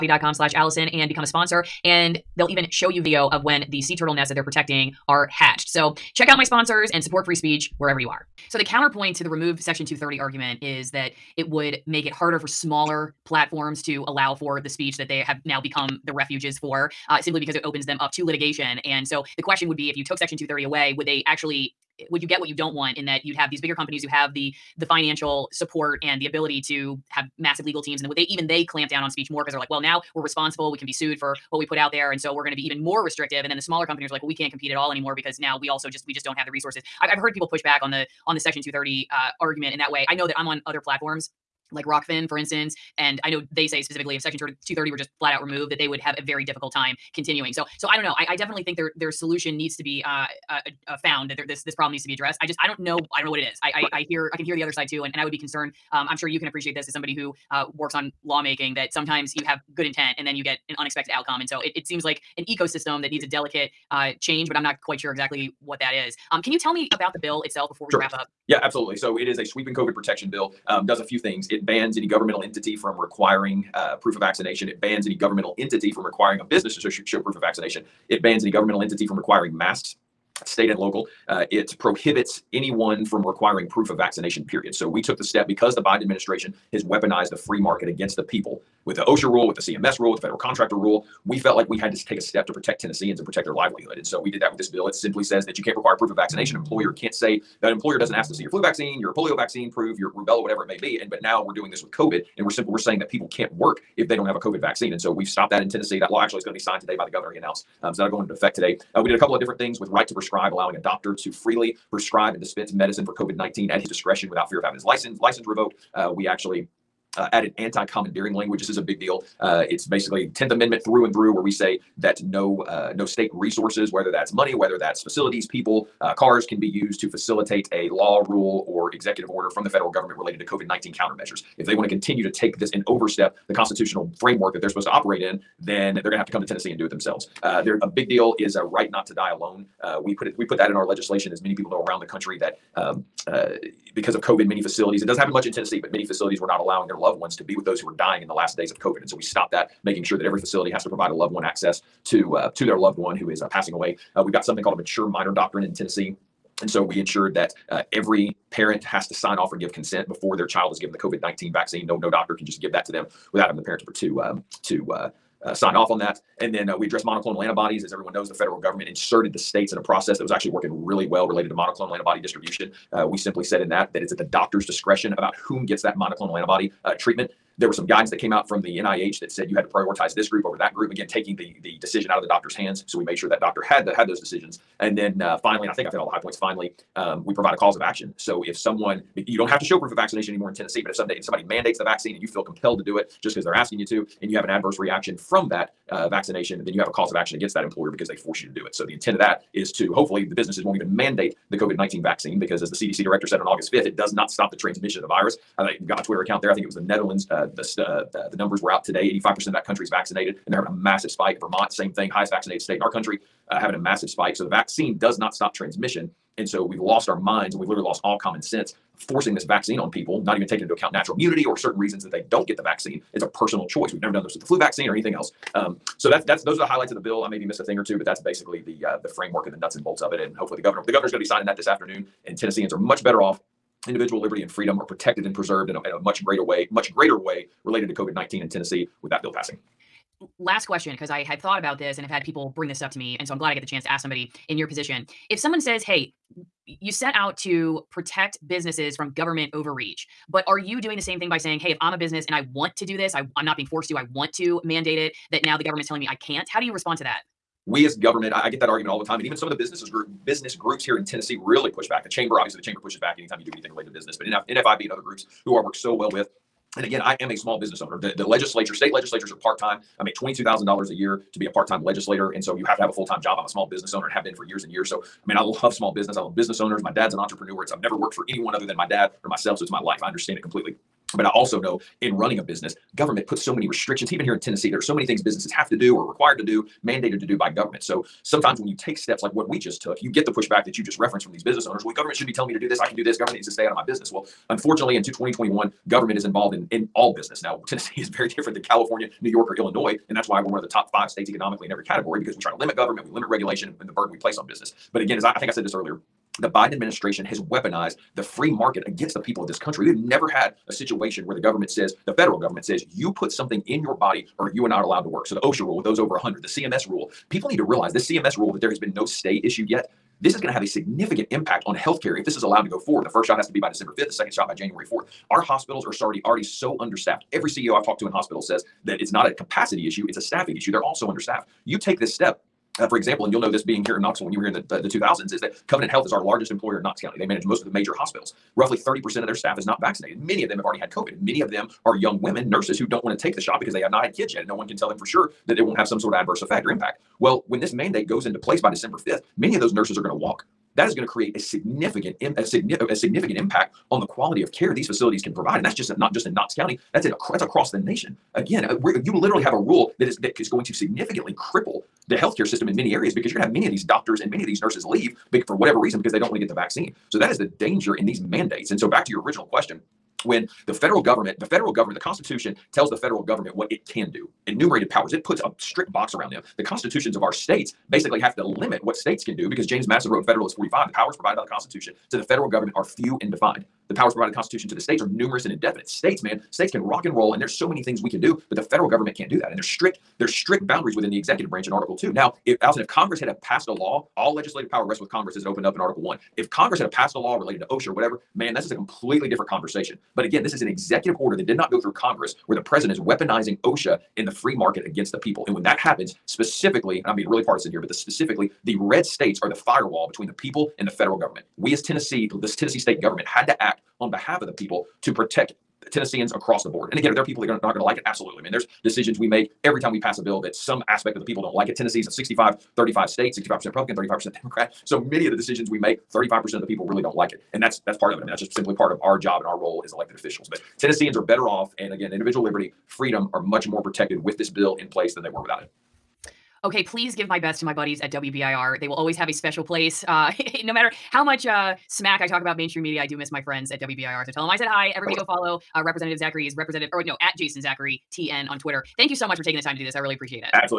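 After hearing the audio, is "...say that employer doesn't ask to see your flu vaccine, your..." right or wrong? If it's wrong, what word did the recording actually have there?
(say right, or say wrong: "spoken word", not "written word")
right.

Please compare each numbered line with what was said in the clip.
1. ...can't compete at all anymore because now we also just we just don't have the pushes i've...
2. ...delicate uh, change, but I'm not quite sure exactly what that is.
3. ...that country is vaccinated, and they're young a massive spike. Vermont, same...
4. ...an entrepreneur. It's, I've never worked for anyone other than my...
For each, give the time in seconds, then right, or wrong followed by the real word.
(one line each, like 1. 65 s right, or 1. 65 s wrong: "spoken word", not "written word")
1. 34 s wrong: "resources", not "pushes"
2. 63 s right
3. 209 s wrong: "having", not "young"
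4. 277 s right.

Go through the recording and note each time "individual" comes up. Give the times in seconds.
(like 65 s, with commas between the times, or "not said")
233 s, 432 s.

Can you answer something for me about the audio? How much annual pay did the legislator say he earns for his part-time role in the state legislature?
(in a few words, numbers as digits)
$22,000.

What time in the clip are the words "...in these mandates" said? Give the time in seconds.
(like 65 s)
367 s.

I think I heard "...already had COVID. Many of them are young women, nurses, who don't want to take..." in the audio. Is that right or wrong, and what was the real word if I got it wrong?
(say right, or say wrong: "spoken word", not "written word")
right.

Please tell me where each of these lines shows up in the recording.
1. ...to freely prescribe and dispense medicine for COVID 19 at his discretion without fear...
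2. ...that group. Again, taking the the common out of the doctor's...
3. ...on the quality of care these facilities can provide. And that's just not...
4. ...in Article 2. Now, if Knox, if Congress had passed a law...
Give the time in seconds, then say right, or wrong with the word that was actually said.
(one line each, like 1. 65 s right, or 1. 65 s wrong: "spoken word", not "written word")
1. 111 s right
2. 180 s wrong: "decision", not "common"
3. 353 s right
4. 391 s wrong: "Alison", not "Knox".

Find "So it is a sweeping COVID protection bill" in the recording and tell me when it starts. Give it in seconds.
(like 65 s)
68 s.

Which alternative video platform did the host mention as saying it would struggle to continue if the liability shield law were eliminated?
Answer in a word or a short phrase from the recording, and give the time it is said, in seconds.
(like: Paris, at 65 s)
Rokfin, at 41 s.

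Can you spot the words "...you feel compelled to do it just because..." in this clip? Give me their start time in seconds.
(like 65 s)
192 s.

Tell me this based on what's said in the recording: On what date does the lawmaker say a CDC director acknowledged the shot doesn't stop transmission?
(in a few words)
August 5th.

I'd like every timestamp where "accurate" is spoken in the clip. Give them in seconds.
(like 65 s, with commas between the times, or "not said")
not said.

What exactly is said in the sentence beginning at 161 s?
No, no doctor can just give that to them without having the parent to, um, to uh, uh, sign off on that.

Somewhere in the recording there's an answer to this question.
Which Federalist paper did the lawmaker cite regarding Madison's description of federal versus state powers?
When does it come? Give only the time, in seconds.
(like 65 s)
380 s.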